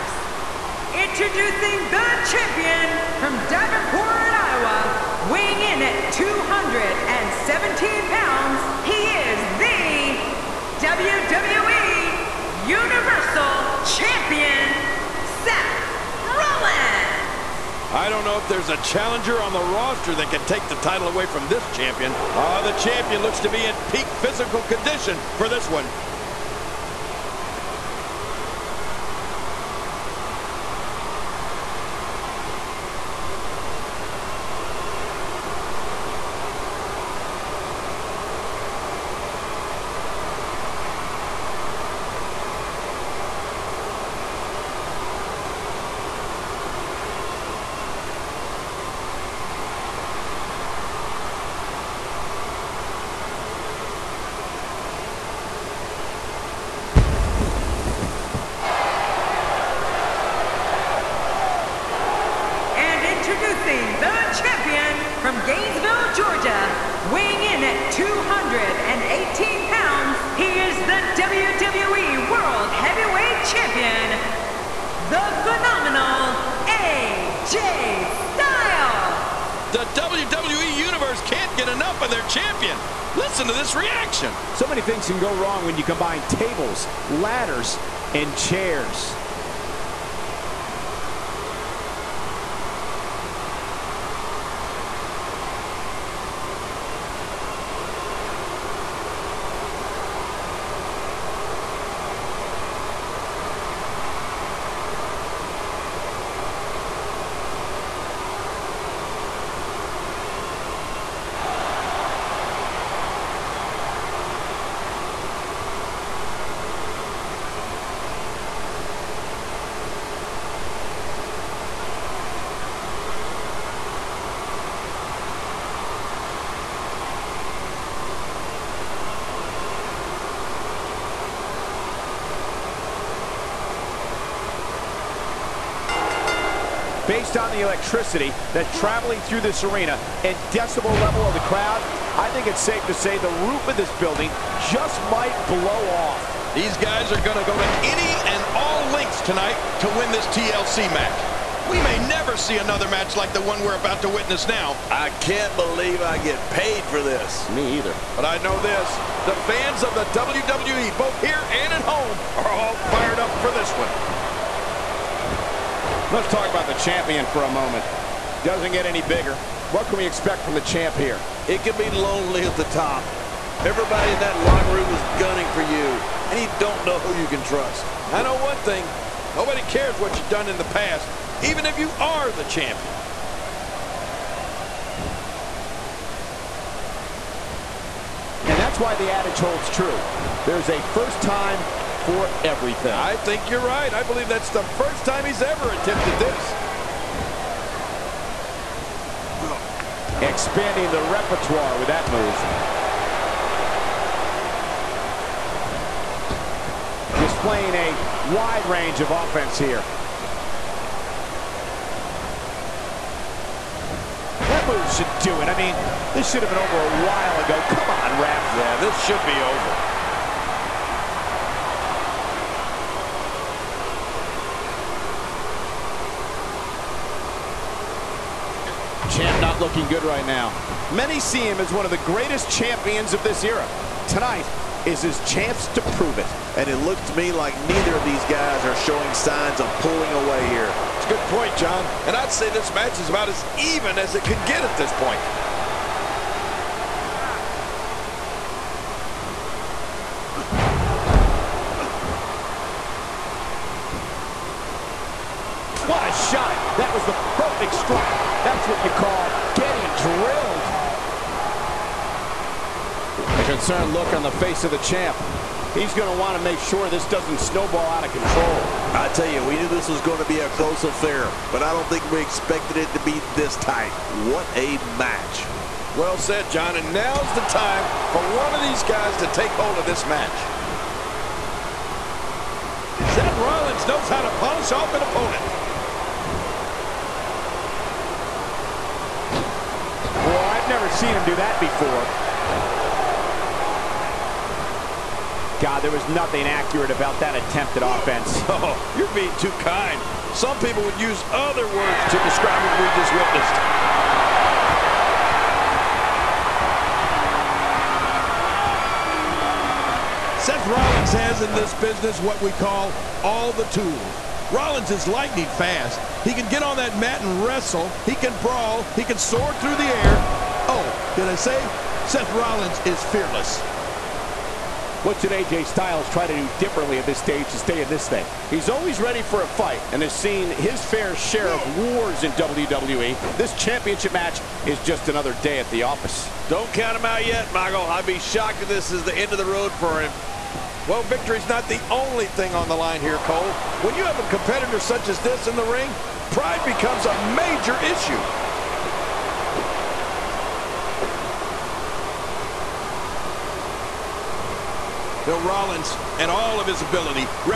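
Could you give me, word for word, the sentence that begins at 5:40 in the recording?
Well, victory's not the only thing on the line here, Cole.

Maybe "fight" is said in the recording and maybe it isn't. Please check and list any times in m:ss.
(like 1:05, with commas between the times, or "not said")
5:29.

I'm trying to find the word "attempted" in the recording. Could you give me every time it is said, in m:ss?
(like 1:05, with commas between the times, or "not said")
3:15, 4:57.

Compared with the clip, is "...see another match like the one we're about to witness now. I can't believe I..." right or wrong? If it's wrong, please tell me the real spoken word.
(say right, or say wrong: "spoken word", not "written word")
right.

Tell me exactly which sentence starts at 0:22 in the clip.
uh, the champion looks to be in peak physical condition for this one.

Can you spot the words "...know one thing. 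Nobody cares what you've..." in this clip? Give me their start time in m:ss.
2:58.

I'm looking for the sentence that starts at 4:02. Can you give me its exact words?
And I'd say this match is about as even as it could get at this point.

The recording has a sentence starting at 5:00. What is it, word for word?
Some people would use other words to describe what we just witnessed.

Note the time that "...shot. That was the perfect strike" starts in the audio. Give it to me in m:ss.
4:16.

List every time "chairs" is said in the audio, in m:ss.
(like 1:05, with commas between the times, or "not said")
1:28.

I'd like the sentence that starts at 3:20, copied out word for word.
Expanding the repertoire with that move.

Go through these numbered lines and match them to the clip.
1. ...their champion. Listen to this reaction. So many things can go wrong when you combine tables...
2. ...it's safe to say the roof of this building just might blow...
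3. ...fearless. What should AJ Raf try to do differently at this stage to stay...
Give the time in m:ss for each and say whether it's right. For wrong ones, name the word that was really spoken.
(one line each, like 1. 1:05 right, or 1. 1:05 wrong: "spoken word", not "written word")
1. 1:22 right
2. 2:22 right
3. 5:23 wrong: "Styles", not "Raf".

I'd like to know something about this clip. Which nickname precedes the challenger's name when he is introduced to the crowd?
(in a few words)
The phenomenal.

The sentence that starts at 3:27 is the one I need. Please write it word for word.
Displaying a wide range of offense here.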